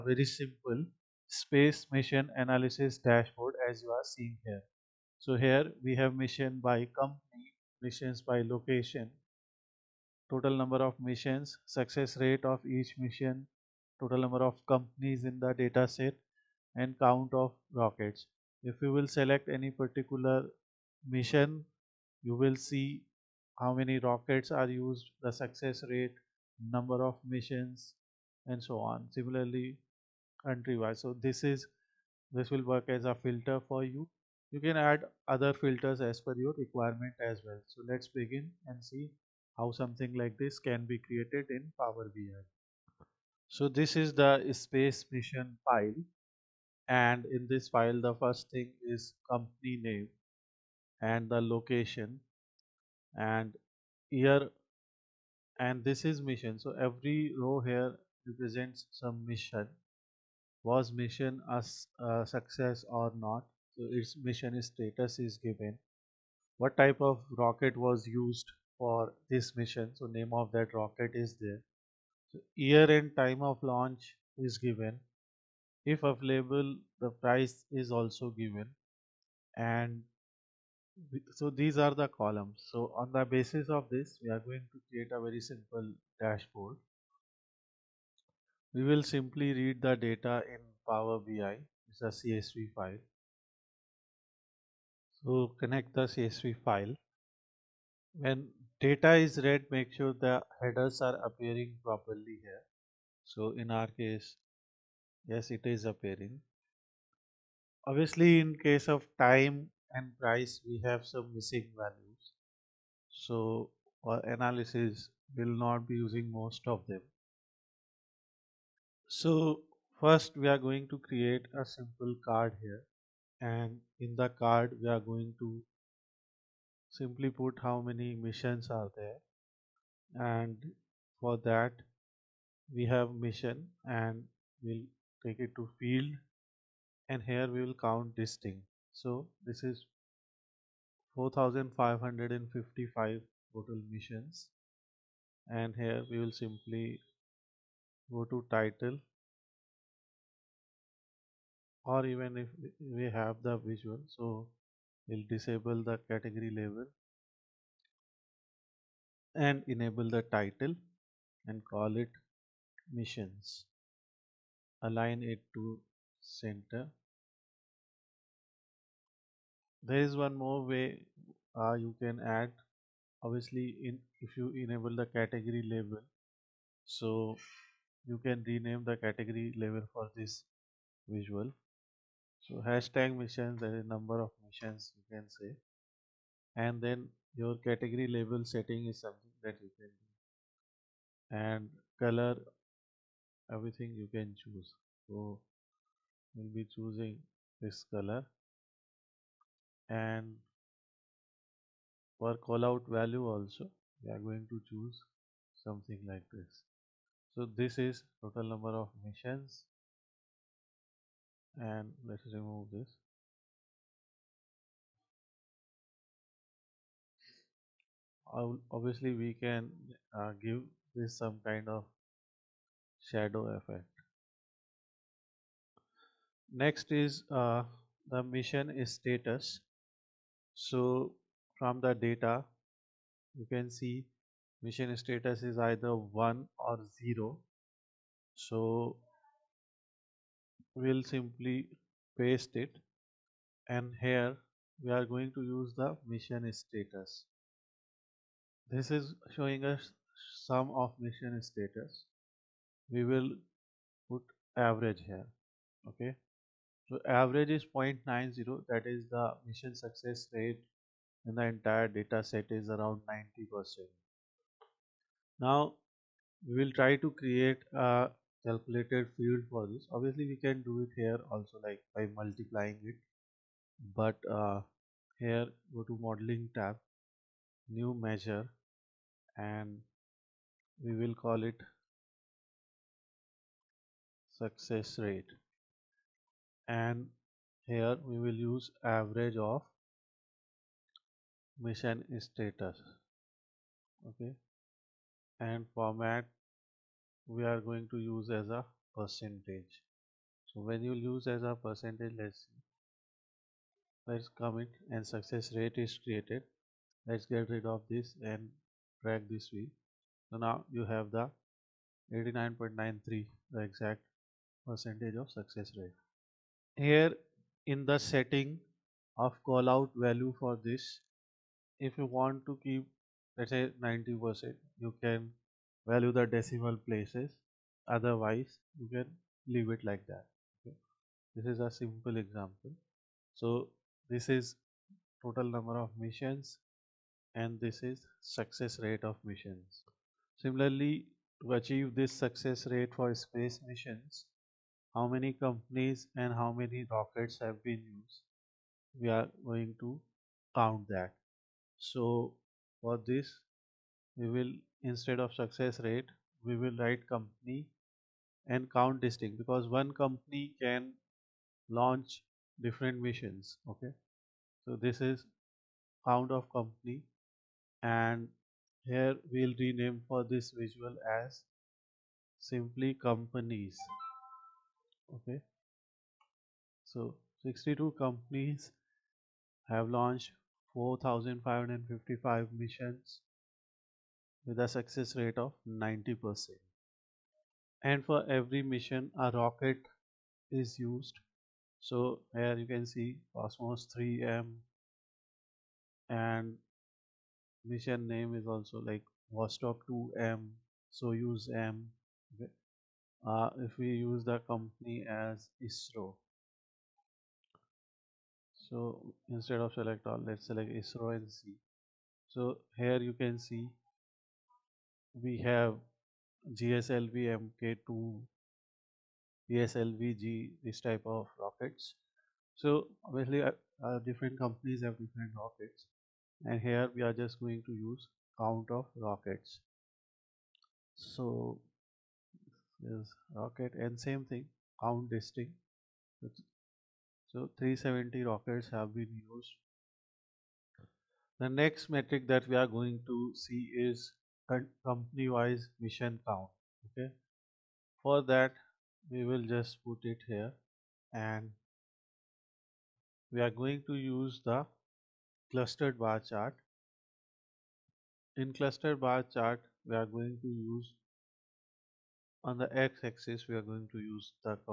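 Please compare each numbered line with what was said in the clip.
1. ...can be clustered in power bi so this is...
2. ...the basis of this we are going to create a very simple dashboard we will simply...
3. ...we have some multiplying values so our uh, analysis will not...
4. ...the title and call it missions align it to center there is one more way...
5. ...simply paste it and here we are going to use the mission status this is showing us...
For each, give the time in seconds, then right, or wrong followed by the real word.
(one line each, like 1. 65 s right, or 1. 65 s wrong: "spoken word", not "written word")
1. 40 s wrong: "created", not "clustered"
2. 83 s right
3. 110 s wrong: "missing", not "multiplying"
4. 160 s right
5. 241 s right.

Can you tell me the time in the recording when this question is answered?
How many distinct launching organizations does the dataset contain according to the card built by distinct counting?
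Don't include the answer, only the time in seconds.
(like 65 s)
377 s.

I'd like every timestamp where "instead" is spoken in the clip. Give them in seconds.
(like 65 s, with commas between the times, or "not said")
354 s, 409 s.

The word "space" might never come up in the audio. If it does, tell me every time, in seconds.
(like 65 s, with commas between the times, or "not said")
1 s, 44 s, 343 s.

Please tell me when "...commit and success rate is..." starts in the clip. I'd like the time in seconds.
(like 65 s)
304 s.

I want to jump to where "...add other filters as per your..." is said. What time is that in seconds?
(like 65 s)
34 s.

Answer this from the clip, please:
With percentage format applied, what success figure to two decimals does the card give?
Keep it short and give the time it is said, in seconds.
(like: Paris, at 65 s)
89.93%, at 312 s.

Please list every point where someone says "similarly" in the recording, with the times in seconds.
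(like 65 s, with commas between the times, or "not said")
29 s, 340 s.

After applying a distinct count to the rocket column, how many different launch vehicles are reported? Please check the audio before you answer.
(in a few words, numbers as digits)
370.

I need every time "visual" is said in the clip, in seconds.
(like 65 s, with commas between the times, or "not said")
153 s, 181 s, 370 s.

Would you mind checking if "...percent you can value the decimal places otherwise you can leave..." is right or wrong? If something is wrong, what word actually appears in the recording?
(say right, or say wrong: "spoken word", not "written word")
right.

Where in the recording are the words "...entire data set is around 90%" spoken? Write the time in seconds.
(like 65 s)
261 s.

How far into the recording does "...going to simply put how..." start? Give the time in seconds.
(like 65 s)
125 s.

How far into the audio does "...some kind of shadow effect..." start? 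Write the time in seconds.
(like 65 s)
221 s.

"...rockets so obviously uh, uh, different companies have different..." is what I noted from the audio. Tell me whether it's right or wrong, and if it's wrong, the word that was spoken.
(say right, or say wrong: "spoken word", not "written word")
right.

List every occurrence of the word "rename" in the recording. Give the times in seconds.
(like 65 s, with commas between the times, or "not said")
178 s, 369 s.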